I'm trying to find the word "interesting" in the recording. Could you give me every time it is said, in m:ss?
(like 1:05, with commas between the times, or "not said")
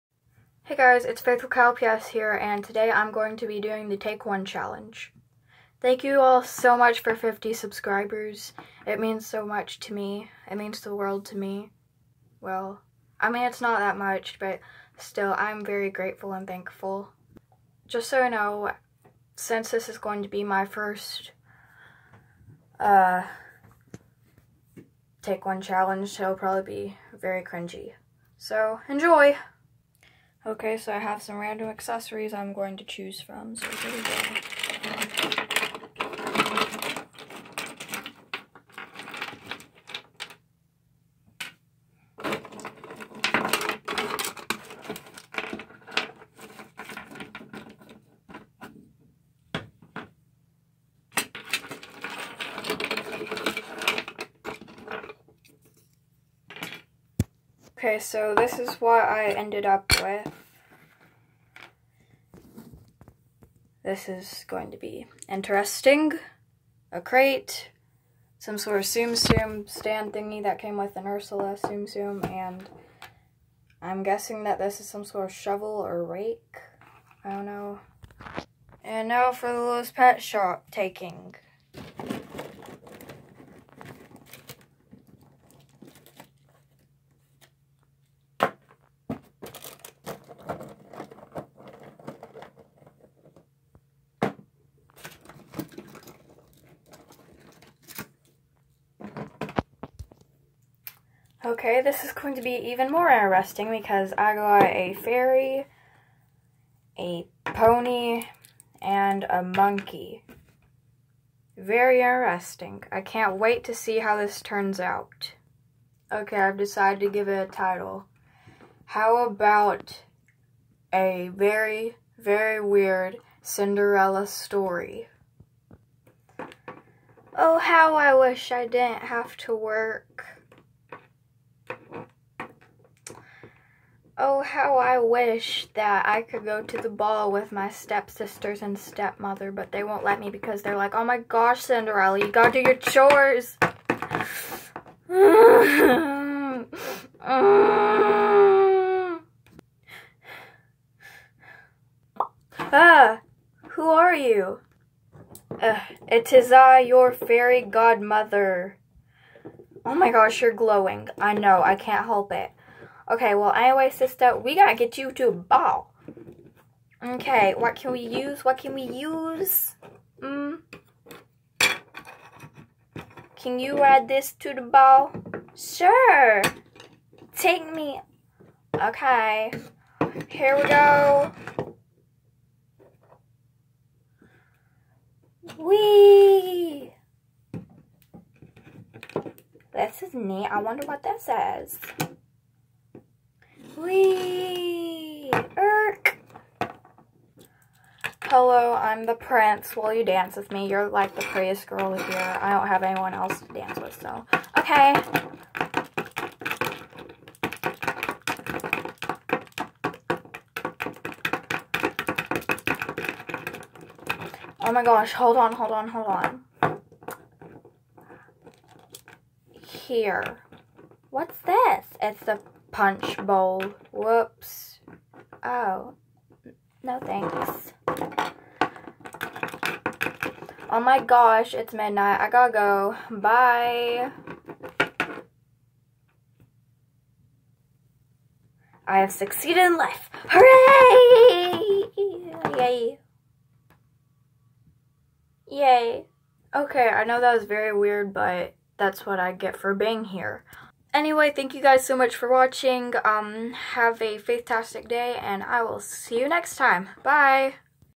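1:05, 1:43, 1:52.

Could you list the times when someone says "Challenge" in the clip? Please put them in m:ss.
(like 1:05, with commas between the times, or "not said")
0:04, 0:25.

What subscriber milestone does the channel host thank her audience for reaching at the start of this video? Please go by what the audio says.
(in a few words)
50.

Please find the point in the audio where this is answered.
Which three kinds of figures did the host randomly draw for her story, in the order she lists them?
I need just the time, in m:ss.
1:44.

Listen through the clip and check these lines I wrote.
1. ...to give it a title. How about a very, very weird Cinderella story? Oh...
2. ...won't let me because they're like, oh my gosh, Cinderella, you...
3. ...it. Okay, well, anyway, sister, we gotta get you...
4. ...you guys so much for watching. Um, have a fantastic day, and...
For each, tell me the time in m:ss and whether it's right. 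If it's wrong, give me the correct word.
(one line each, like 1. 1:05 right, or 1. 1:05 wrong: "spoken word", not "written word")
1. 1:56 right
2. 2:19 right
3. 2:42 right
4. 4:11 right.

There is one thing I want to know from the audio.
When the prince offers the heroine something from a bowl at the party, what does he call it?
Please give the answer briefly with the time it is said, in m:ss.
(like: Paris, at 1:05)
punch bowl, at 3:42.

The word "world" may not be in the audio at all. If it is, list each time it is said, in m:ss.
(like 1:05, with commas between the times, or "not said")
0:10.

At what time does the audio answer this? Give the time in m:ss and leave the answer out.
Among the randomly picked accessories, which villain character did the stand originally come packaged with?
1:11.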